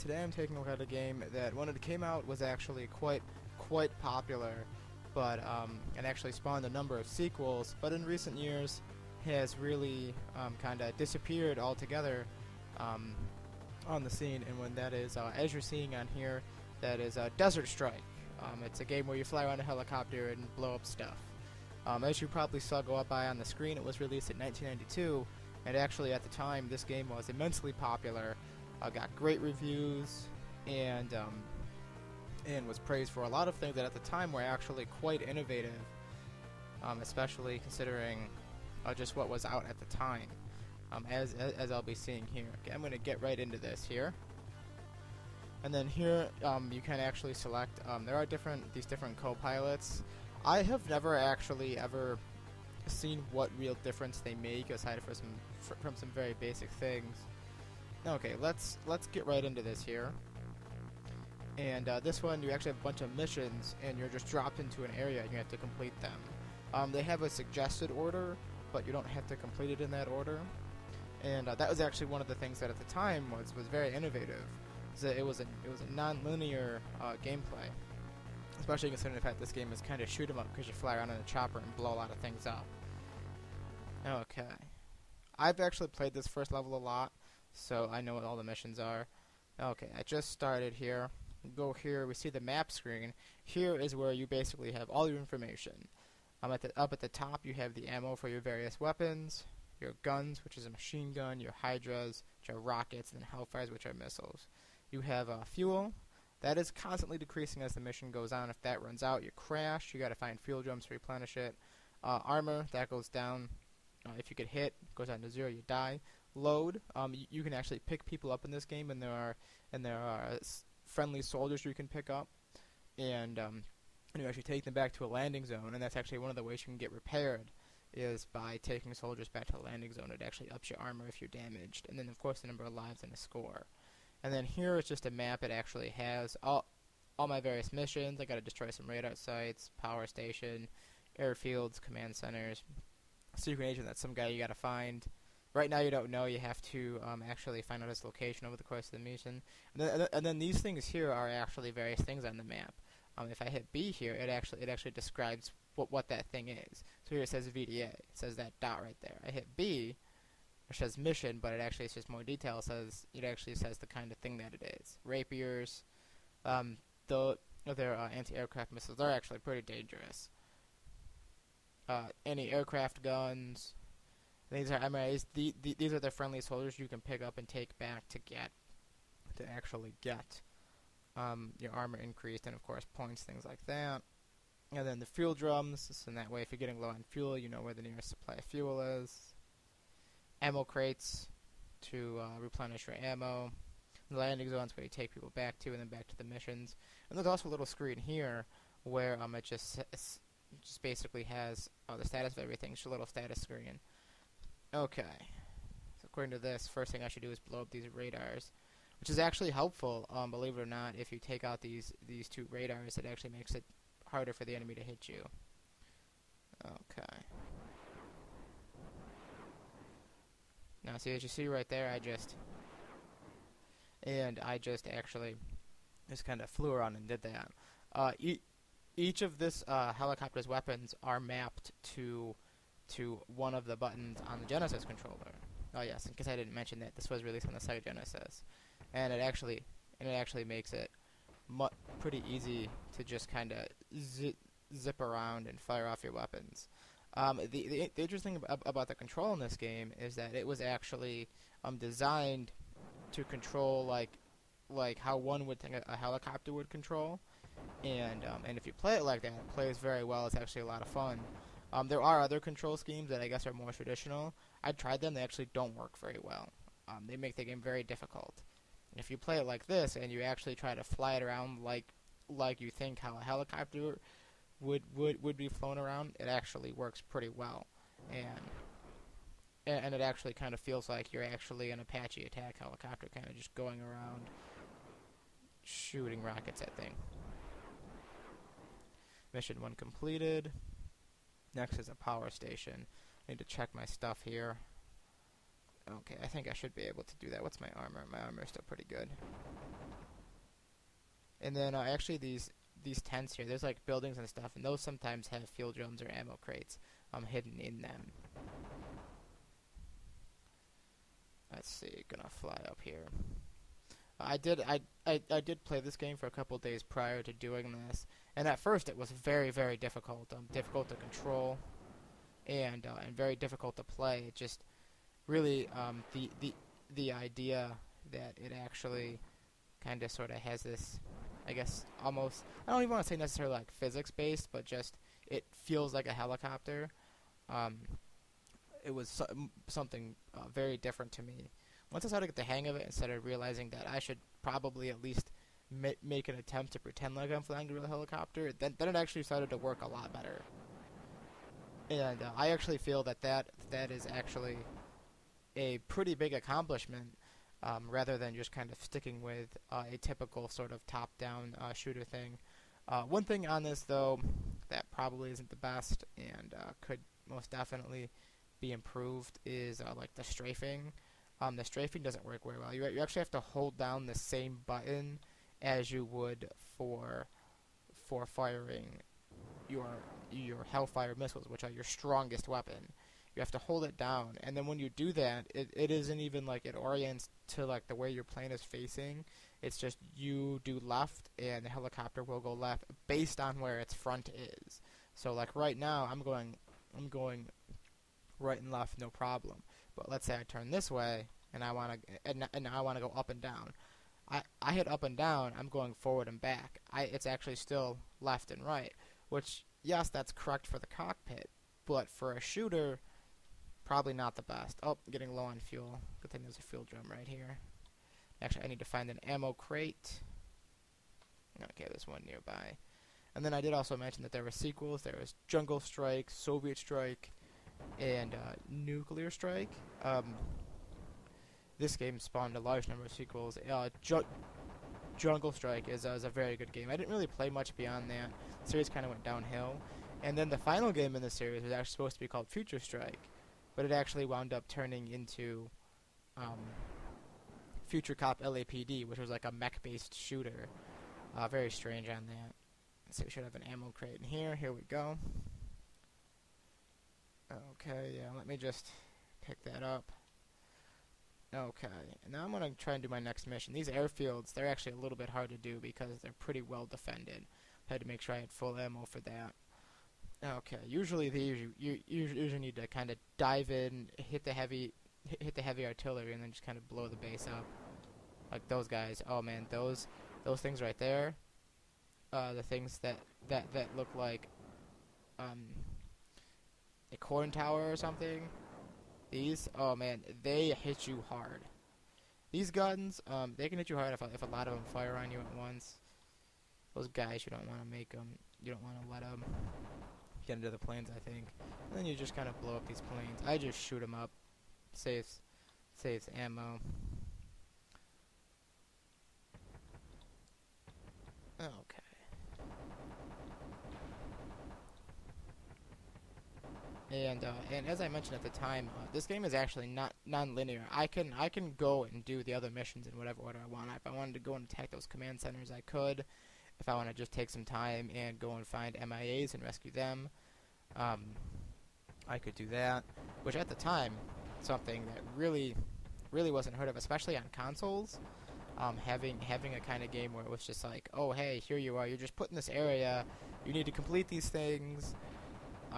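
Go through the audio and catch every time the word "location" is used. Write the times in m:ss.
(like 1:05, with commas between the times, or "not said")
2:28.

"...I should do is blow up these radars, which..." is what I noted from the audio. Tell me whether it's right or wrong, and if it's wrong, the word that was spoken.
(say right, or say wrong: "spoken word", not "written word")
right.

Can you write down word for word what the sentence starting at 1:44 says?
You have uh, fuel, that is constantly decreasing as the mission goes on.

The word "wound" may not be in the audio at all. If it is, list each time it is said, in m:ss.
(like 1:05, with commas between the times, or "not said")
7:24.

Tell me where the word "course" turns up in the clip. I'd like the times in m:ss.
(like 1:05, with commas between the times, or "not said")
2:12, 2:28, 3:02.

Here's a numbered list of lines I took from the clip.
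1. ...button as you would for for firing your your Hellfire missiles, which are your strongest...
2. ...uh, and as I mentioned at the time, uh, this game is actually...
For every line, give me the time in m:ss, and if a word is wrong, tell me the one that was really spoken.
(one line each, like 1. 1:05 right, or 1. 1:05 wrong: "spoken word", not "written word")
1. 6:14 right
2. 8:37 right.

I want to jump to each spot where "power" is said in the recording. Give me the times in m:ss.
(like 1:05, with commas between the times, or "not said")
2:19, 4:51.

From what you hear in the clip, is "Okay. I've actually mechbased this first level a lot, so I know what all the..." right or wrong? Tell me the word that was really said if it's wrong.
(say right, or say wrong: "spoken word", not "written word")
wrong: "played", not "mechbased".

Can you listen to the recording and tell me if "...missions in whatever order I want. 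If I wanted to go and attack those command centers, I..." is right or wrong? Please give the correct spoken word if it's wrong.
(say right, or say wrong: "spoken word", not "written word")
right.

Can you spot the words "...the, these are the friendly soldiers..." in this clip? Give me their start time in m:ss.
2:55.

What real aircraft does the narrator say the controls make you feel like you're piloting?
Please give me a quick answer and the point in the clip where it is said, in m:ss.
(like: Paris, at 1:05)
Apache attack helicopter, at 4:41.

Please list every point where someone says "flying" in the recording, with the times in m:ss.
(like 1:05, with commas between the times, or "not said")
5:47.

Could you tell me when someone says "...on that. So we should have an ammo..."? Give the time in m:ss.
7:32.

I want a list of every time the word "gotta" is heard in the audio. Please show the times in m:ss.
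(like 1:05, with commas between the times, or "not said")
2:18, 2:24.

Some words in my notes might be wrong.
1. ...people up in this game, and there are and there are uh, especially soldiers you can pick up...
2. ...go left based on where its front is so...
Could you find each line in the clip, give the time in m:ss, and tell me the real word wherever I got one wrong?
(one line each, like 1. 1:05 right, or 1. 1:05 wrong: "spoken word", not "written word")
1. 1:58 wrong: "friendly", not "especially"
2. 6:32 right.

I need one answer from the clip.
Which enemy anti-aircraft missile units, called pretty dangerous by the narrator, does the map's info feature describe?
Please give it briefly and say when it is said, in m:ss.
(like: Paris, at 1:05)
Rapiers, at 2:45.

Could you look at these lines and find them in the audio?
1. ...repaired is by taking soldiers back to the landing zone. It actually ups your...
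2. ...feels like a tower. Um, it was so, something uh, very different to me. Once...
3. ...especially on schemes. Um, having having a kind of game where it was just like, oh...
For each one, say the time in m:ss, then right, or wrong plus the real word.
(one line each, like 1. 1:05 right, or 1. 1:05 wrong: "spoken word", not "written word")
1. 2:06 right
2. 5:35 wrong: "helicopter", not "tower"
3. 8:56 wrong: "consoles", not "schemes".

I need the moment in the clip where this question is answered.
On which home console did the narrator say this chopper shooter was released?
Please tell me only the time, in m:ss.
3:57.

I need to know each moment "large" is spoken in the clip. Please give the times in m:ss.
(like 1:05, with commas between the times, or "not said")
7:12.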